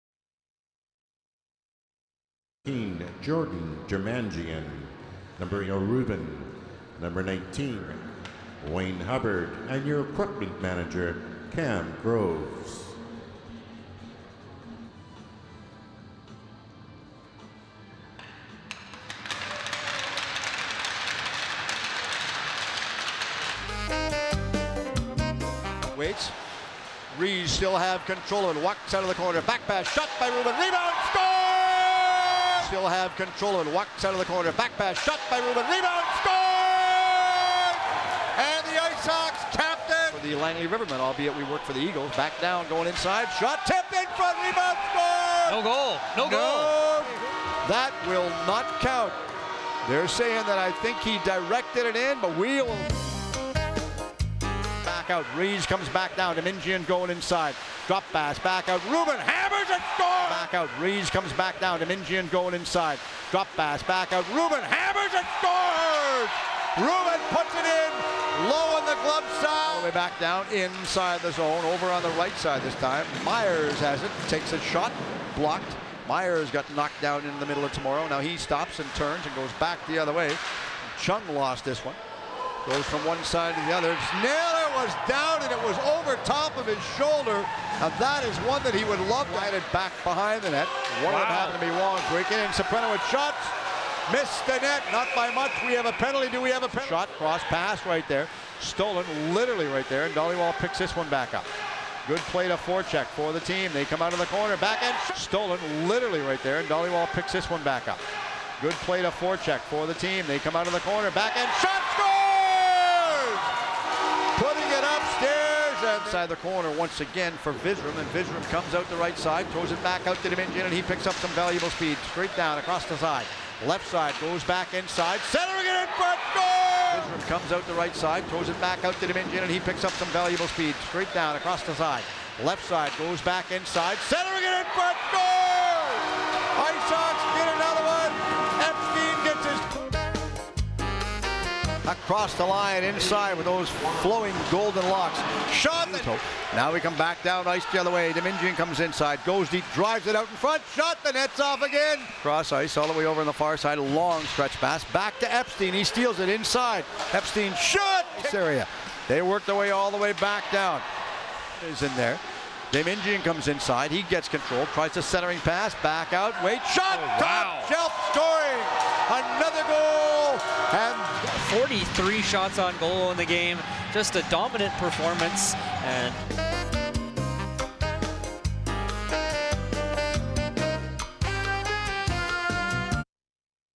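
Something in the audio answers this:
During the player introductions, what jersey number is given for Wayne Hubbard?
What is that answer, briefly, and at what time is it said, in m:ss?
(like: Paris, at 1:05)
19, at 0:07.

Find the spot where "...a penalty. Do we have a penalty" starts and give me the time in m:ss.
1:35.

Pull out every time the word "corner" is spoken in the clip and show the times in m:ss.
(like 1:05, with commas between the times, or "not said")
0:29, 0:34, 1:44, 1:50, 1:56.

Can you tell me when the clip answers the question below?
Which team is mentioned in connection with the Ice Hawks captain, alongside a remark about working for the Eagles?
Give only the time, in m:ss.
0:40.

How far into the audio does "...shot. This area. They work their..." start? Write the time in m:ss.
2:37.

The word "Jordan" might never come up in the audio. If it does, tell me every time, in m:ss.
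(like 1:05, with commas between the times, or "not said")
0:03.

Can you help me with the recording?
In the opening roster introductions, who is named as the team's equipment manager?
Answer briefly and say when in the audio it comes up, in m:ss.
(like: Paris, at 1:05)
Cam Groves, at 0:11.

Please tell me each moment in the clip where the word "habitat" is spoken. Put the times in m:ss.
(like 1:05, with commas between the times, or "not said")
not said.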